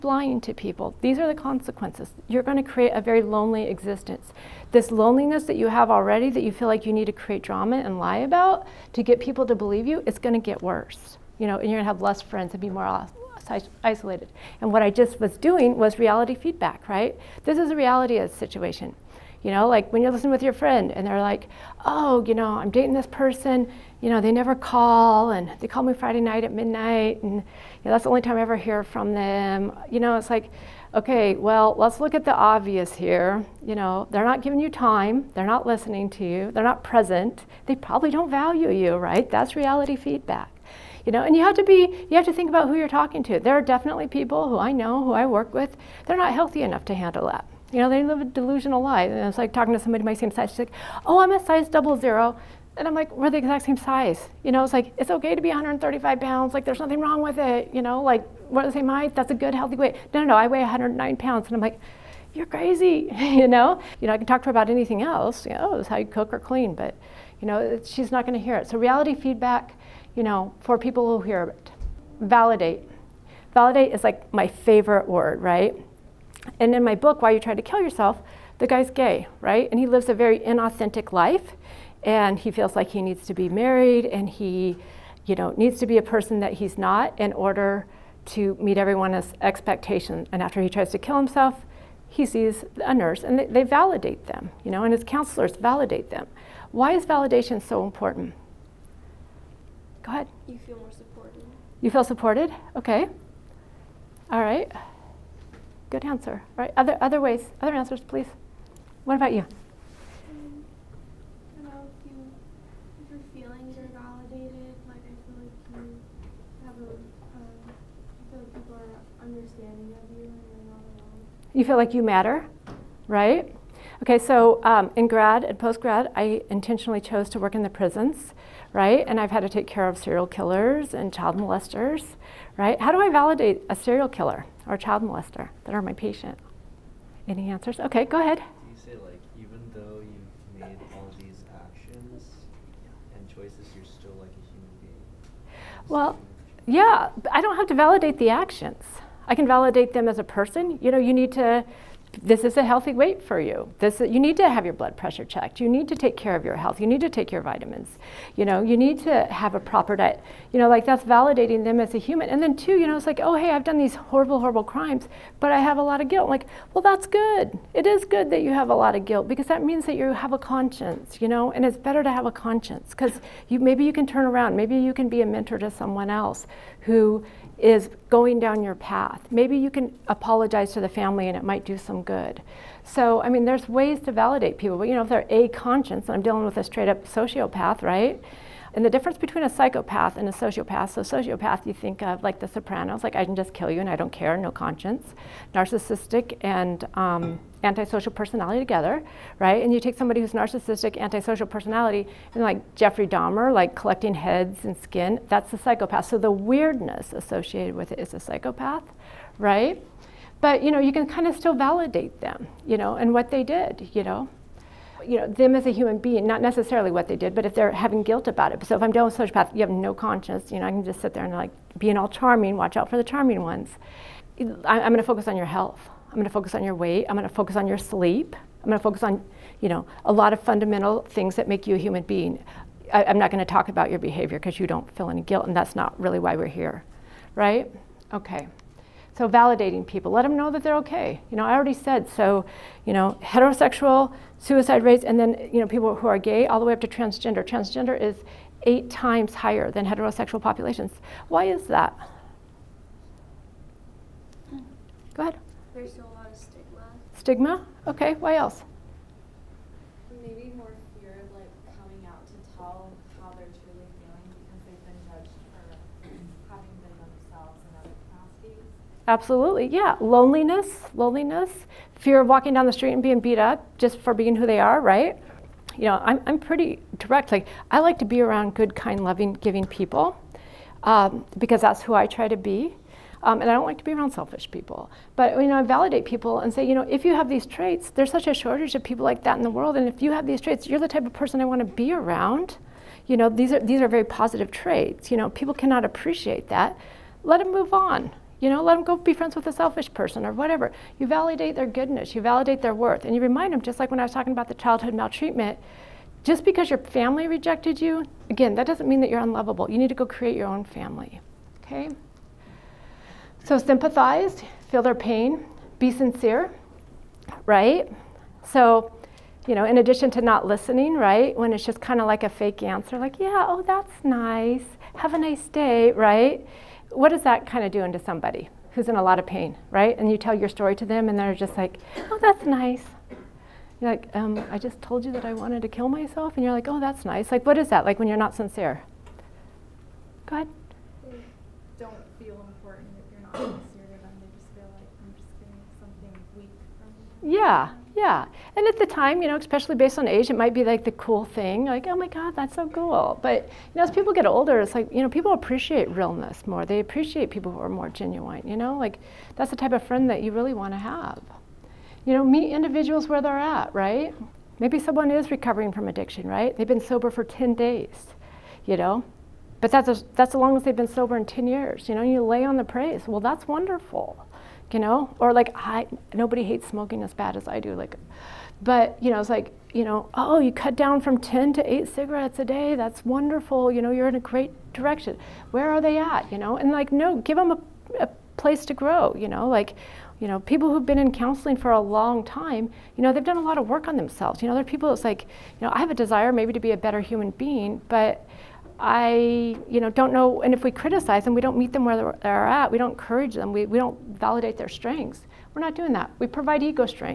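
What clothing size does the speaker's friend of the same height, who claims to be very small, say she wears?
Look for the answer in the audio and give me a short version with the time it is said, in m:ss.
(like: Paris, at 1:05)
double zero, at 0:51.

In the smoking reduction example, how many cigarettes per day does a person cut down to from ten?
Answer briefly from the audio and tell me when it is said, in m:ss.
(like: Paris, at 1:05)
8, at 6:21.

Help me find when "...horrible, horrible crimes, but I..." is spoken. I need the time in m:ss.
2:43.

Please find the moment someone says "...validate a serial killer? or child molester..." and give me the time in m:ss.
2:13.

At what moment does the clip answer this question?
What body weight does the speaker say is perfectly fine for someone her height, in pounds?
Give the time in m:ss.
0:55.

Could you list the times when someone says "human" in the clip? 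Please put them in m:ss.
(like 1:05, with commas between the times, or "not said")
2:24, 2:41, 3:35, 3:51, 6:37.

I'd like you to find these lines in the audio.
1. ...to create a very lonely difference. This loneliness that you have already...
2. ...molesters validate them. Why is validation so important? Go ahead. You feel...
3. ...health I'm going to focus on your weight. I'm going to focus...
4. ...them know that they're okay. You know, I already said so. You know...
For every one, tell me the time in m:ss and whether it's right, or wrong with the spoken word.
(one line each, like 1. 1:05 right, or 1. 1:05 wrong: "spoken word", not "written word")
1. 0:02 wrong: "existence", not "difference"
2. 1:35 wrong: "counselors", not "molesters"
3. 3:45 right
4. 4:00 right.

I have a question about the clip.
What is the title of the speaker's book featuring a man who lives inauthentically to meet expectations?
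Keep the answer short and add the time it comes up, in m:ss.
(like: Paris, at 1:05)
Why You Tried to Kill Yourself, at 1:17.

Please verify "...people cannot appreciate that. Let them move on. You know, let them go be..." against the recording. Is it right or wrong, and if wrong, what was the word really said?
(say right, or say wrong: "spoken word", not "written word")
right.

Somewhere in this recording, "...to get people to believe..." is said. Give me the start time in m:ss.
0:08.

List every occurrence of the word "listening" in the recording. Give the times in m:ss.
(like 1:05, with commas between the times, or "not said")
0:20, 0:35, 5:20.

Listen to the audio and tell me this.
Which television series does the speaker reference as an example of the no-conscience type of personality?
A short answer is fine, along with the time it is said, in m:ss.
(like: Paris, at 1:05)
The Sopranos, at 3:12.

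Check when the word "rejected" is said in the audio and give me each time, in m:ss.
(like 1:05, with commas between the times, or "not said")
5:07.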